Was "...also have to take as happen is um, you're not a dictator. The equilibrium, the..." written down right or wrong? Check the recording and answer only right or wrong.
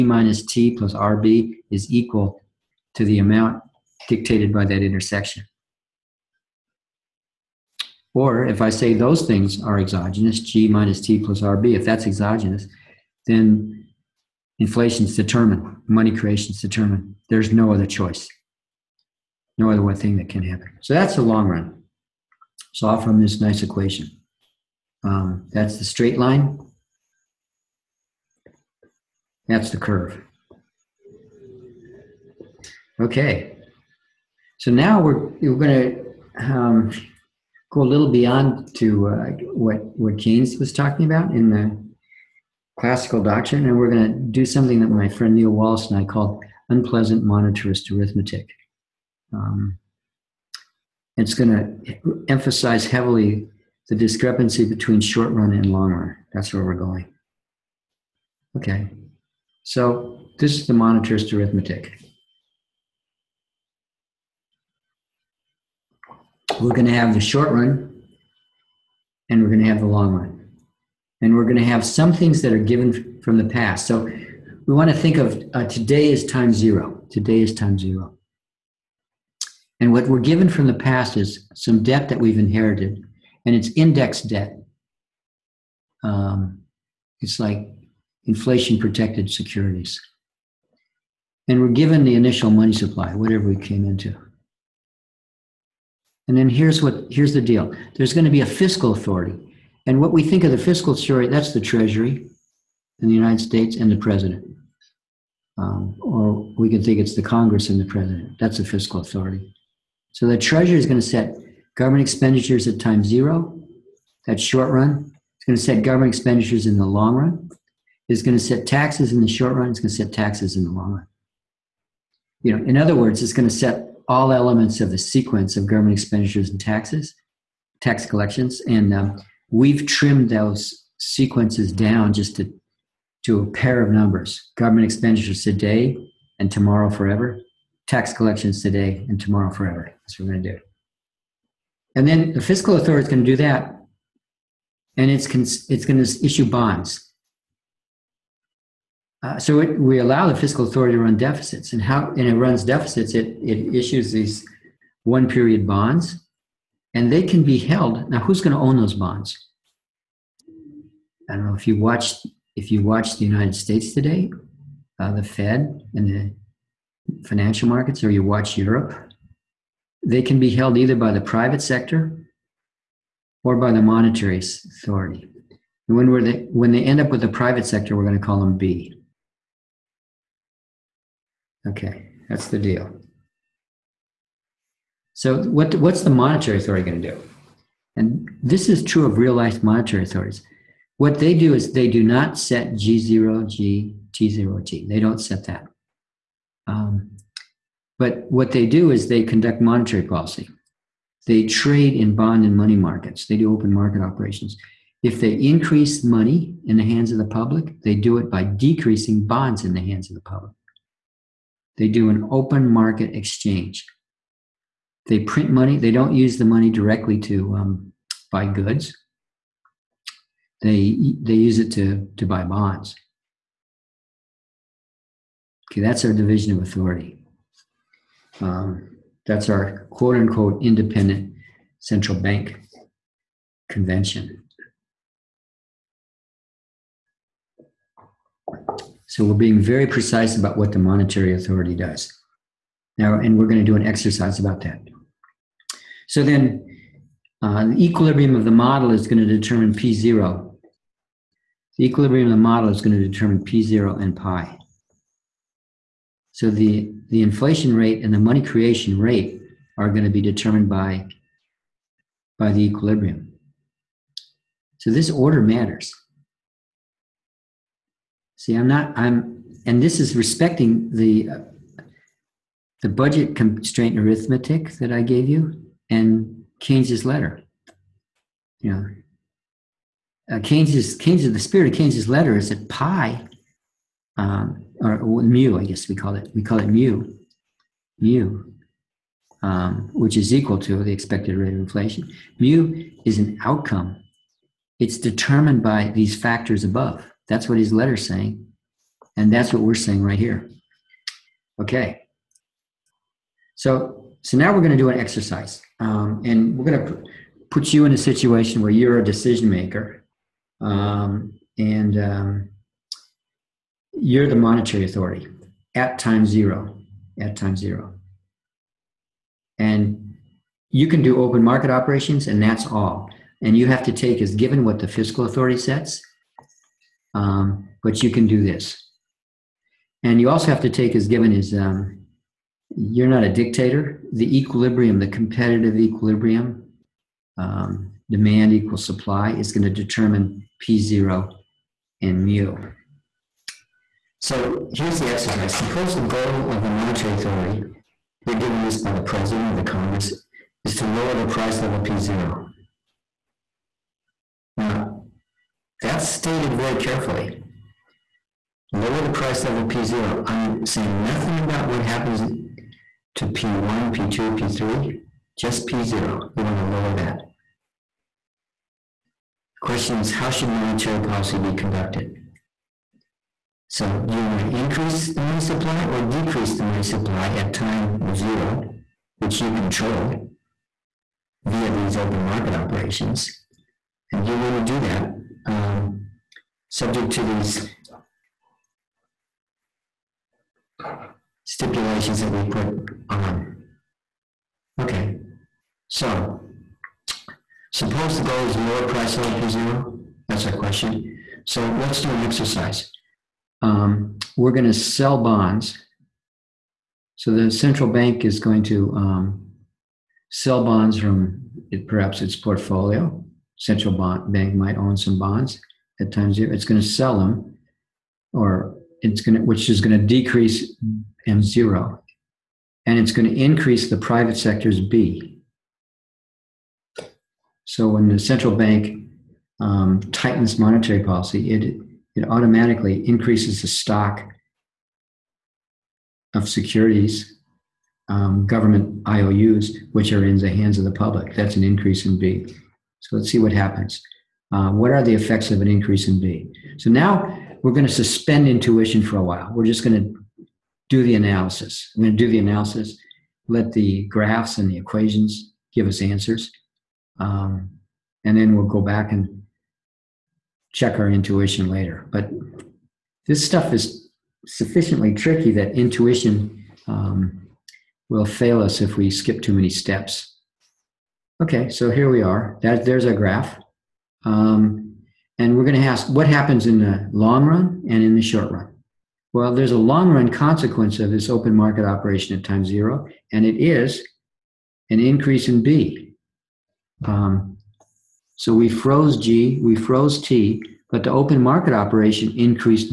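wrong.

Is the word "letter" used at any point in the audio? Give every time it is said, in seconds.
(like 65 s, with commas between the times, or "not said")
277 s, 282 s, 297 s.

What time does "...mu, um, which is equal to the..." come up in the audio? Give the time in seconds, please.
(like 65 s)
287 s.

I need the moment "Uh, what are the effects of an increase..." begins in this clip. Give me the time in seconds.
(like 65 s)
444 s.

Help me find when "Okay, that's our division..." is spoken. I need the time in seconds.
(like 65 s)
225 s.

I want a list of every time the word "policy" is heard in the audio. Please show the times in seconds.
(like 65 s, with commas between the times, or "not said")
200 s, 370 s, 431 s.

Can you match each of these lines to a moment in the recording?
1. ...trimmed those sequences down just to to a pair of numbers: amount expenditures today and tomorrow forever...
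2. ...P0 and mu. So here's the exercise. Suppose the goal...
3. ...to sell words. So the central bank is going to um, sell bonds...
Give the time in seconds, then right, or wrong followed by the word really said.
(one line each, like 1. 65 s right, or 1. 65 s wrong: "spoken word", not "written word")
1. 129 s wrong: "government", not "amount"
2. 340 s right
3. 404 s wrong: "bonds", not "words".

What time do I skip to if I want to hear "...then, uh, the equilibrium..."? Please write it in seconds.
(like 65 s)
246 s.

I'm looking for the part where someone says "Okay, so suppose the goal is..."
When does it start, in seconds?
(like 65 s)
394 s.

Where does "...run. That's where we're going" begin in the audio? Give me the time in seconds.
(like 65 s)
55 s.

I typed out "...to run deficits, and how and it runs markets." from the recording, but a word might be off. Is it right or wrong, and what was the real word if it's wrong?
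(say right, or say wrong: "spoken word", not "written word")
wrong: "deficits", not "markets".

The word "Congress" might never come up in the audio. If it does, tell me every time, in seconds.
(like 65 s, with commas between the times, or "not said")
107 s, 349 s.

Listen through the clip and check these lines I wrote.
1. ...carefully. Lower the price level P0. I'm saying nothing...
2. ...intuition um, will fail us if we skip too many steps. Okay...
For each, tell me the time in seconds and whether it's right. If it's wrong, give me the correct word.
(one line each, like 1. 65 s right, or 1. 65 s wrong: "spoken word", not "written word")
1. 356 s right
2. 465 s right.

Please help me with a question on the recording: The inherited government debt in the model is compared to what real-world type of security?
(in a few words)
Inflation protected securities.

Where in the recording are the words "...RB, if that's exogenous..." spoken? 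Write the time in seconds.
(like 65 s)
11 s.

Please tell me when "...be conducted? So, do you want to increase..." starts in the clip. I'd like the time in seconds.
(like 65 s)
371 s.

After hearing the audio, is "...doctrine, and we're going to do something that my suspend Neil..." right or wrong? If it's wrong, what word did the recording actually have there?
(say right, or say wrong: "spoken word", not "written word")
wrong: "friend", not "suspend".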